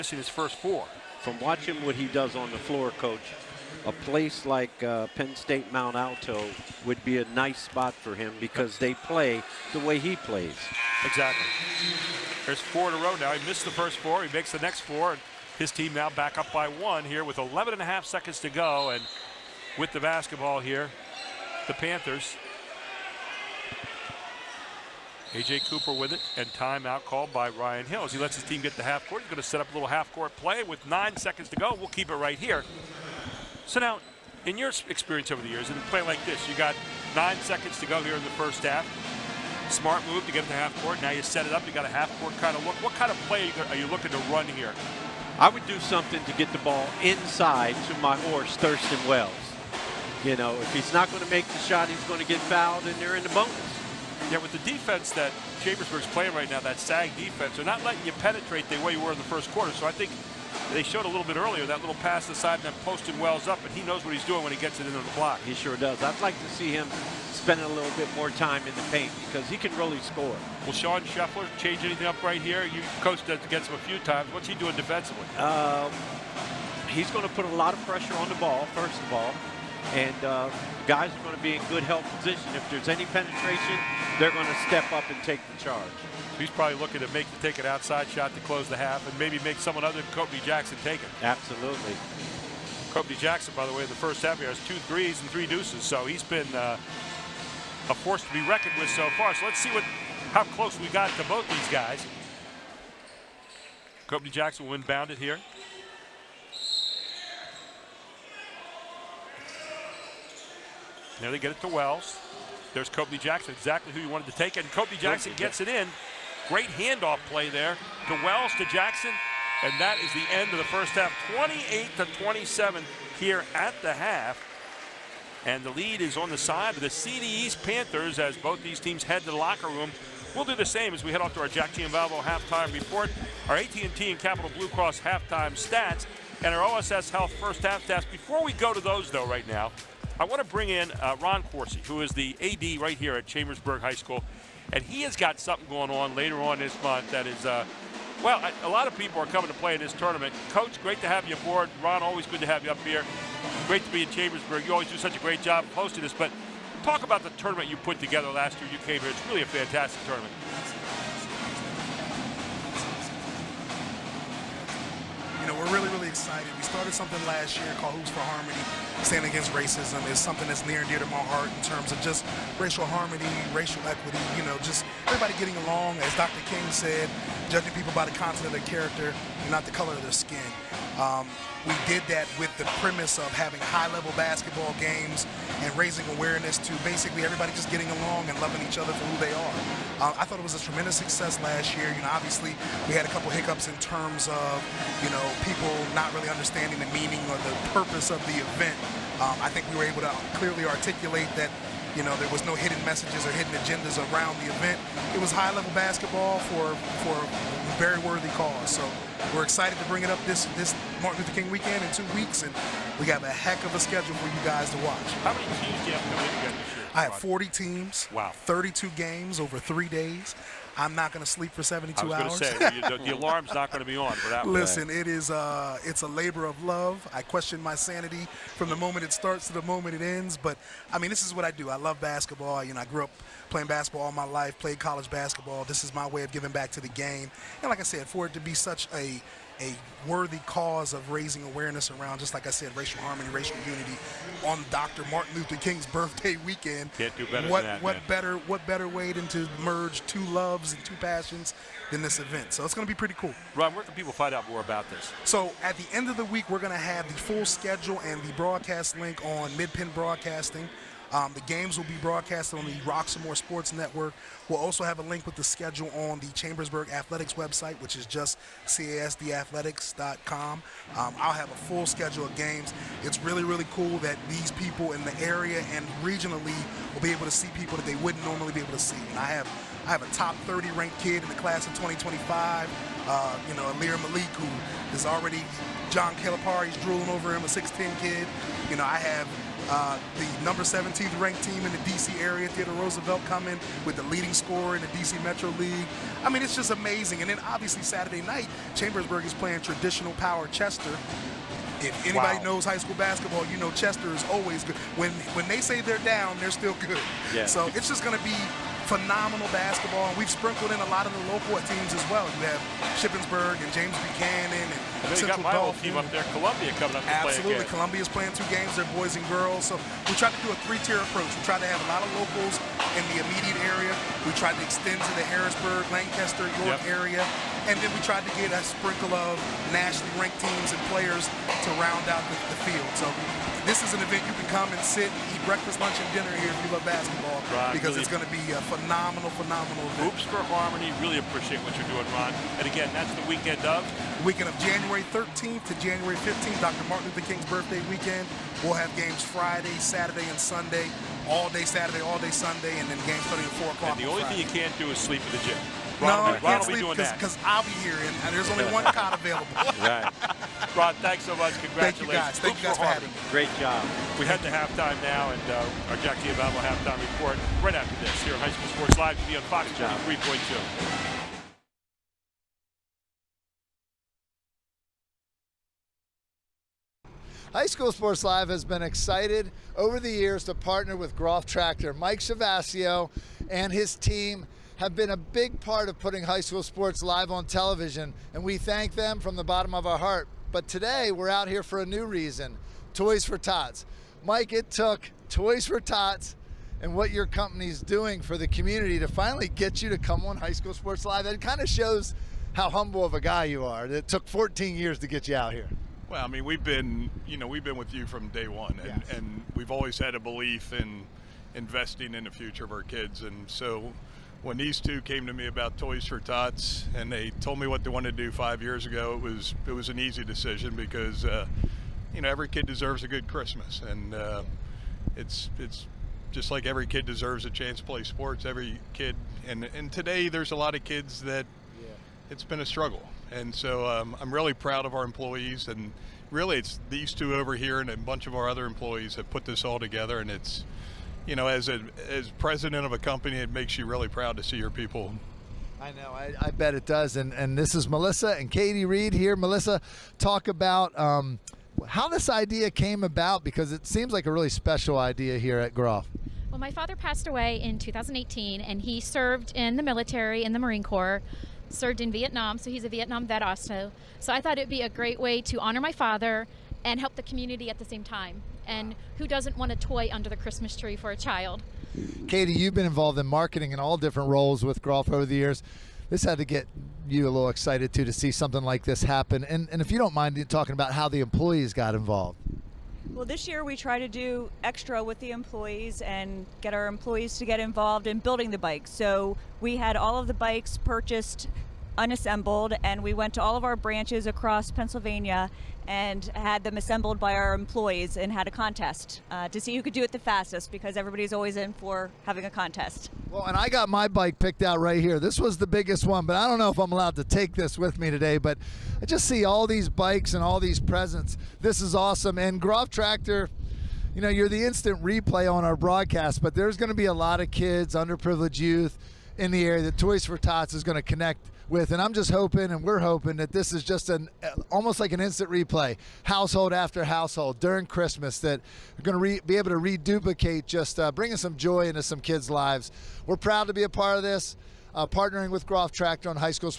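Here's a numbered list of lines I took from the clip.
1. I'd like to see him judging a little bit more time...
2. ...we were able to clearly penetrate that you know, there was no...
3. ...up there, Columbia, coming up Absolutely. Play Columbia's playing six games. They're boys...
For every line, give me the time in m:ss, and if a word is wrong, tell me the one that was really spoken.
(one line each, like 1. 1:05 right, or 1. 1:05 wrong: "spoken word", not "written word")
1. 1:06 wrong: "spending", not "judging"
2. 3:19 wrong: "articulate", not "penetrate"
3. 5:15 wrong: "two", not "six".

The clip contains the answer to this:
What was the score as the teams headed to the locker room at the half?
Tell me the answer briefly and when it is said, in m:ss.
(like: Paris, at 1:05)
28 to 27, at 2:01.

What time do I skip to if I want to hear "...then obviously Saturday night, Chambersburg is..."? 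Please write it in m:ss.
4:57.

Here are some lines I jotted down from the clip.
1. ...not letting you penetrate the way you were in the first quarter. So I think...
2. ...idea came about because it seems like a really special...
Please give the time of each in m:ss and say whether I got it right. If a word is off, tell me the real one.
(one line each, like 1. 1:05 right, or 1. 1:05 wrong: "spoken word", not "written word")
1. 0:57 right
2. 7:32 right.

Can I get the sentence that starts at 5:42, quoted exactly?
And again, that's the weekend of?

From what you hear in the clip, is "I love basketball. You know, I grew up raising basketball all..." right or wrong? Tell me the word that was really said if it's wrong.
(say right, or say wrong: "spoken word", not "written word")
wrong: "playing", not "raising".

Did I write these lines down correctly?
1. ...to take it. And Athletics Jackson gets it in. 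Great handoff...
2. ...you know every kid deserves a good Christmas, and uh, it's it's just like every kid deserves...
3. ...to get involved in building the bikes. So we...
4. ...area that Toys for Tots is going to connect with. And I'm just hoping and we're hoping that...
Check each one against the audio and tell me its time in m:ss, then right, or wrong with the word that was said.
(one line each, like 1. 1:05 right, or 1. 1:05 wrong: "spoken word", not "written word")
1. 1:54 wrong: "Kobe", not "Athletics"
2. 7:02 right
3. 8:07 right
4. 8:39 right.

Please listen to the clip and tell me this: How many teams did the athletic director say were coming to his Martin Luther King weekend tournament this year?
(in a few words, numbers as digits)
40.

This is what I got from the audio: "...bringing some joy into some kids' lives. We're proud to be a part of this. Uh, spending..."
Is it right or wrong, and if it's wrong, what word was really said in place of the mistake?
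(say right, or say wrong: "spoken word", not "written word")
wrong: "partnering", not "spending".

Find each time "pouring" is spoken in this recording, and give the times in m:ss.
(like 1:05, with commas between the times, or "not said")
not said.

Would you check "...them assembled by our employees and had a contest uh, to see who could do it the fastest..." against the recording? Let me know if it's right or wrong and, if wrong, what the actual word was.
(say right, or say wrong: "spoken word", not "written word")
right.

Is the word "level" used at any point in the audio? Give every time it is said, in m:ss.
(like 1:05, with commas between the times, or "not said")
3:03, 3:25.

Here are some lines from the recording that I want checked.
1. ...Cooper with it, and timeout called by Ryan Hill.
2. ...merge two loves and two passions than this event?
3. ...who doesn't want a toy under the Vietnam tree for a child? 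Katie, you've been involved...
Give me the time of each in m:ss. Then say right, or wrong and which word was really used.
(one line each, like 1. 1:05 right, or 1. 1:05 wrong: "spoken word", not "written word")
1. 0:25 right
2. 4:09 right
3. 7:49 wrong: "Christmas", not "Vietnam".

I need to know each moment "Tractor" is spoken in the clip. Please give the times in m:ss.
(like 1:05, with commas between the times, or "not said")
6:21, 8:32, 8:55.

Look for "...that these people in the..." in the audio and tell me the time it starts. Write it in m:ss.
4:33.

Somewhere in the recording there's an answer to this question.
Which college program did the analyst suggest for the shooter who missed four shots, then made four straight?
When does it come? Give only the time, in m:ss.
0:05.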